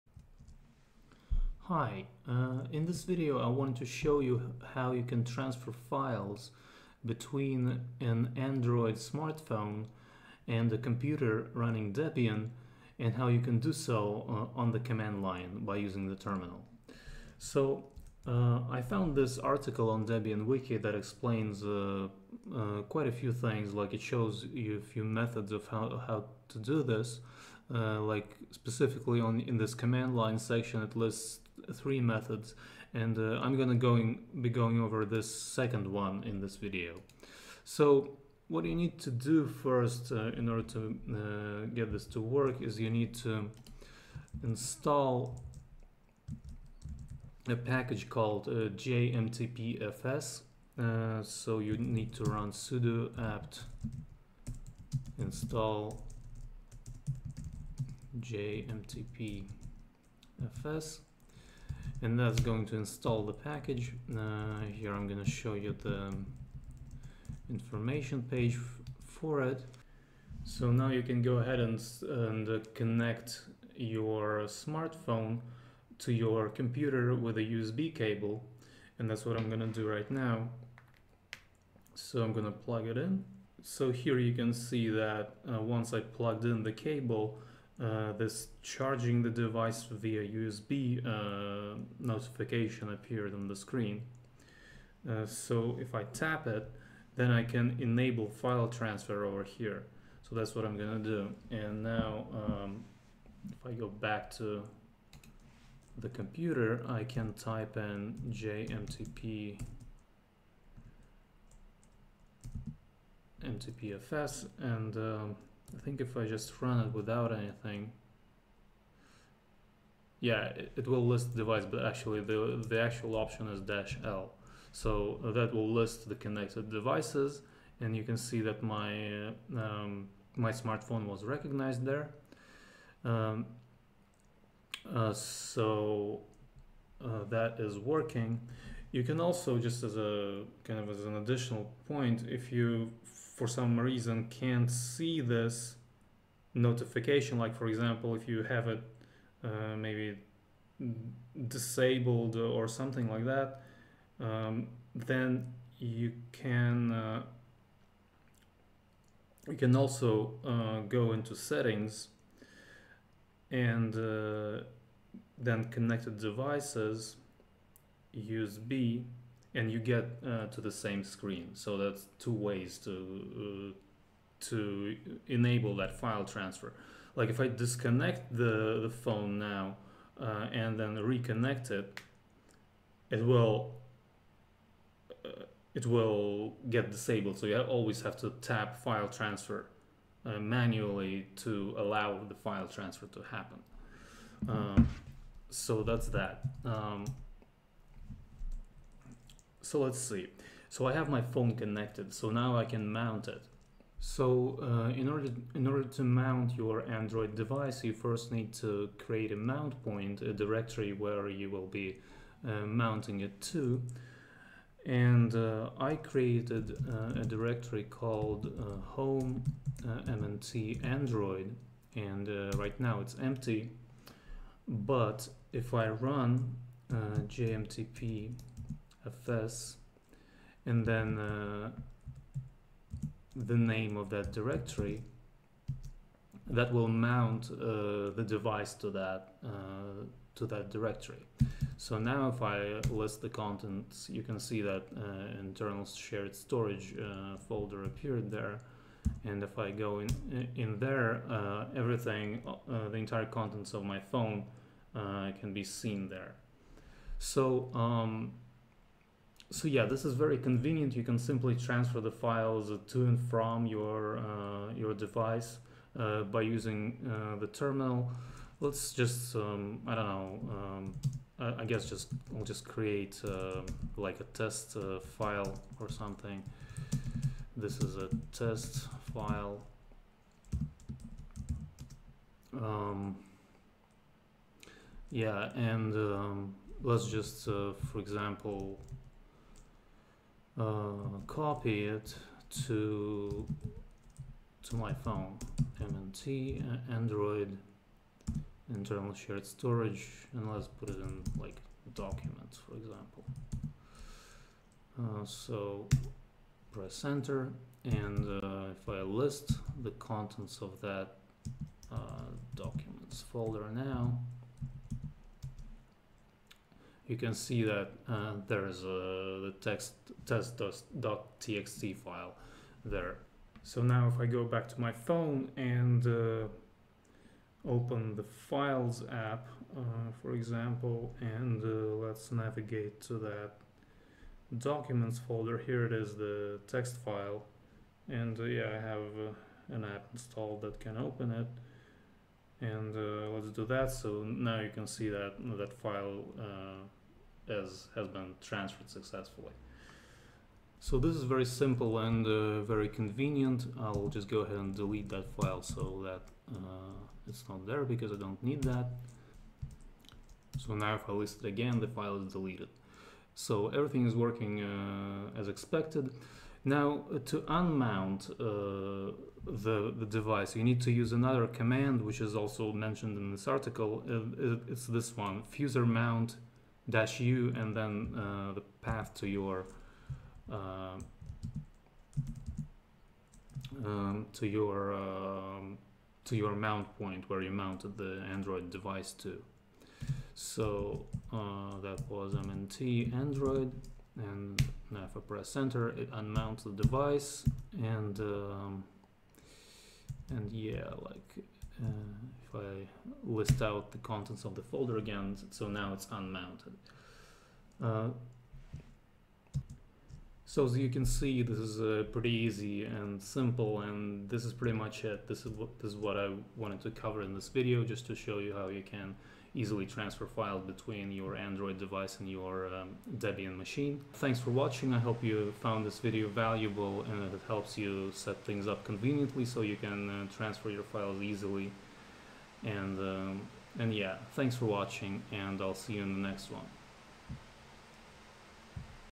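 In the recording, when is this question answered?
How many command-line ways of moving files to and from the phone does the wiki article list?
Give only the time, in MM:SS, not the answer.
00:31.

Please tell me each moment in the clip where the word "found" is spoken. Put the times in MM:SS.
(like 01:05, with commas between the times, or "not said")
00:18, 07:05.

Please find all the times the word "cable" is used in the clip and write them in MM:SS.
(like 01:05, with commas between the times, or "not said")
01:17, 01:26.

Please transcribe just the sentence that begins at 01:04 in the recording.
Uh, here I'm going to show you the information page for it.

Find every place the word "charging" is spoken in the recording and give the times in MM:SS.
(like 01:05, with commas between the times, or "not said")
01:28.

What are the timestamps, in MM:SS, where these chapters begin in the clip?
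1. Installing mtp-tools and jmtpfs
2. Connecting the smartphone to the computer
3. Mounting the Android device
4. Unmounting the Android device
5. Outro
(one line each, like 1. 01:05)
1. 00:37
2. 01:09
3. 03:19
4. 06:06
5. 06:49.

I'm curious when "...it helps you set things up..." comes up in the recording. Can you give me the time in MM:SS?
07:07.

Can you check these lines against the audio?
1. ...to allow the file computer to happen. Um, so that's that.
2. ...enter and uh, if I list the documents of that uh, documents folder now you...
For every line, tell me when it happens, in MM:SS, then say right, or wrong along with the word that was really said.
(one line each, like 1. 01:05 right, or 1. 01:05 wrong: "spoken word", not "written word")
1. 03:11 wrong: "transfer", not "computer"
2. 05:07 wrong: "contents", not "documents".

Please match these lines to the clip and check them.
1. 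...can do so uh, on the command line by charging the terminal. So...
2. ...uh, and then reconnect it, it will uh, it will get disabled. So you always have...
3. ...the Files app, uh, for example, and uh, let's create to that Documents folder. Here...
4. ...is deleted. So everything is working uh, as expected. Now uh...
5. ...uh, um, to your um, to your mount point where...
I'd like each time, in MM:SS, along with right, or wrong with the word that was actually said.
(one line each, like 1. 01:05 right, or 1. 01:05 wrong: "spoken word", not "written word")
1. 00:13 wrong: "using", not "charging"
2. 03:00 right
3. 05:28 wrong: "navigate", not "create"
4. 06:02 right
5. 06:20 right.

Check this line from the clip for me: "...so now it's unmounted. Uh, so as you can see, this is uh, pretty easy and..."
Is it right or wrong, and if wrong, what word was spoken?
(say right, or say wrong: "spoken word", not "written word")
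right.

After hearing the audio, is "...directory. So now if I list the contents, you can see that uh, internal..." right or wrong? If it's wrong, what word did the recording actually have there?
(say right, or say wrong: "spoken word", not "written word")
right.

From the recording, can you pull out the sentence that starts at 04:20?
You can simply transfer the files to and from your uh, your device uh, by using uh, the terminal.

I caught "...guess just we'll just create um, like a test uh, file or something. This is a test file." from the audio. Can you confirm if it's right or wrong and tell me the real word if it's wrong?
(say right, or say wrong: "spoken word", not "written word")
right.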